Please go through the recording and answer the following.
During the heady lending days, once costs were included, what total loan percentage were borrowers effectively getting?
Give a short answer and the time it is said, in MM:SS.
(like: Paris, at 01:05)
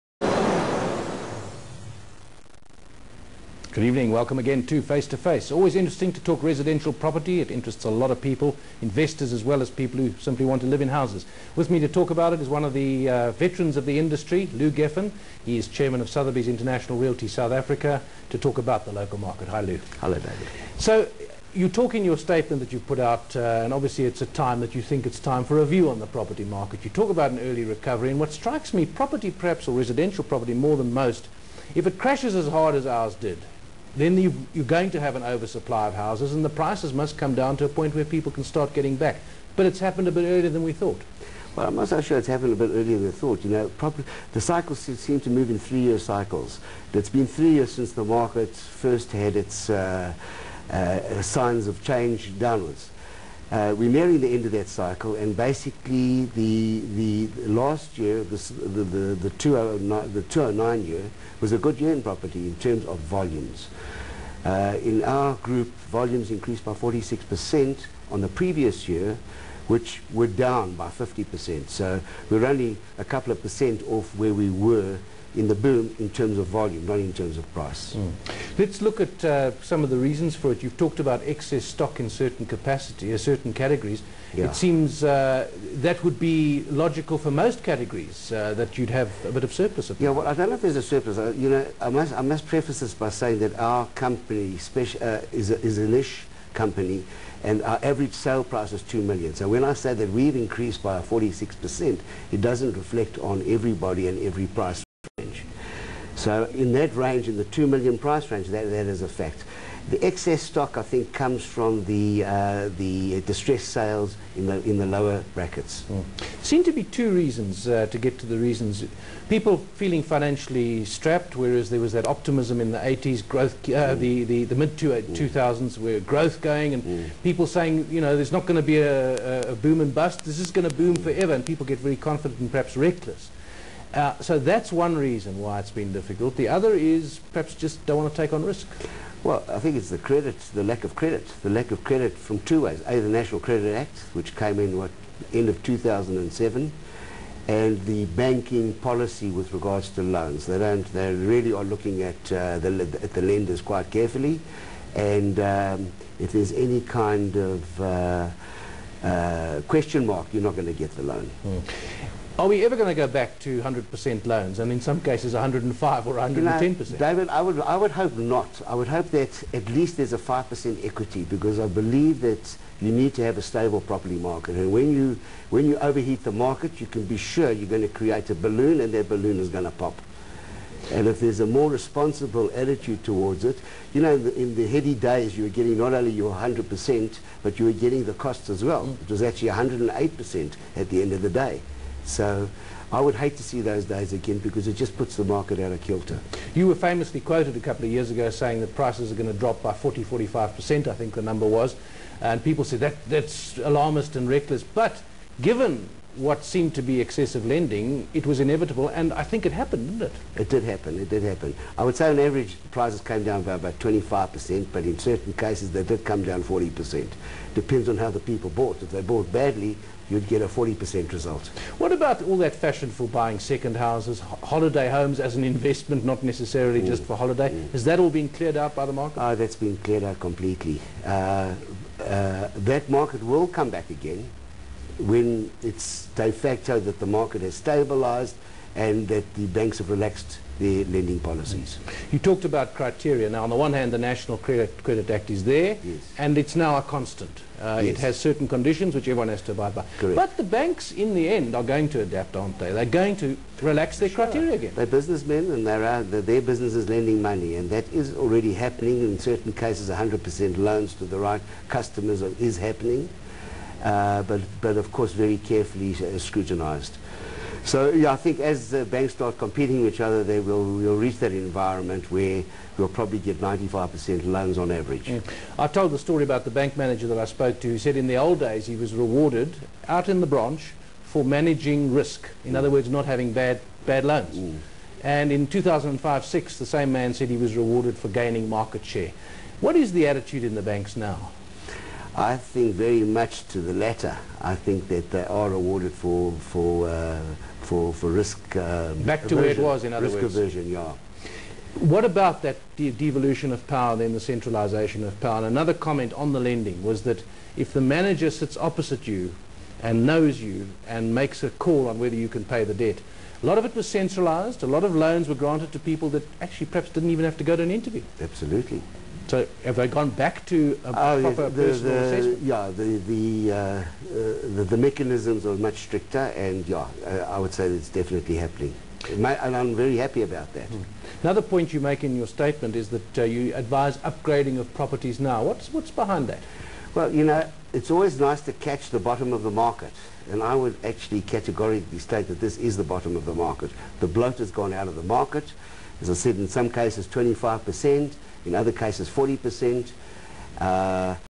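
108%, at 03:09.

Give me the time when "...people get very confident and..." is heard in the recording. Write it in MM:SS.
02:11.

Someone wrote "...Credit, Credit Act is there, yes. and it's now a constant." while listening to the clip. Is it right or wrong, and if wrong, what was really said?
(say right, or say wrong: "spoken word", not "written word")
right.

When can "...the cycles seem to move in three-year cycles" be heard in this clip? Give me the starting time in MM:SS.
00:44.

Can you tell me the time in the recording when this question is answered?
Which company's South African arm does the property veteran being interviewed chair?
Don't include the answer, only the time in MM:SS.
00:16.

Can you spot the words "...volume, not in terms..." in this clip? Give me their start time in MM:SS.
01:16.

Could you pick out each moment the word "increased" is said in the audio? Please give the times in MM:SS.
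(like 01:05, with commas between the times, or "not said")
01:06, 01:40.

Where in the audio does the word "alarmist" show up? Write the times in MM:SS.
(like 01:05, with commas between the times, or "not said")
03:23.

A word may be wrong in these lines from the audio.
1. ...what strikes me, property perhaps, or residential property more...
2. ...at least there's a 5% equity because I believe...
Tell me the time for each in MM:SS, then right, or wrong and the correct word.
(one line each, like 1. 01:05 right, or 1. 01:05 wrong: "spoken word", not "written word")
1. 00:28 right
2. 02:49 right.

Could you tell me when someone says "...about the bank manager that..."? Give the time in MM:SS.
04:36.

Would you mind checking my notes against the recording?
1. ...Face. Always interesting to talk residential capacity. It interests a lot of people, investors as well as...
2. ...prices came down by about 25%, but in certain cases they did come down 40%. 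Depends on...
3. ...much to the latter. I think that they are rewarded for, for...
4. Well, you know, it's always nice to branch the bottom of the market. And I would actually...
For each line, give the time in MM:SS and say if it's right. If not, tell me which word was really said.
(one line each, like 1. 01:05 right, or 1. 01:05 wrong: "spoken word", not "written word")
1. 00:05 wrong: "property", not "capacity"
2. 03:32 right
3. 04:53 right
4. 05:36 wrong: "catch", not "branch".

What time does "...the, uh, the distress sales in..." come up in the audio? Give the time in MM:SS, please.
01:51.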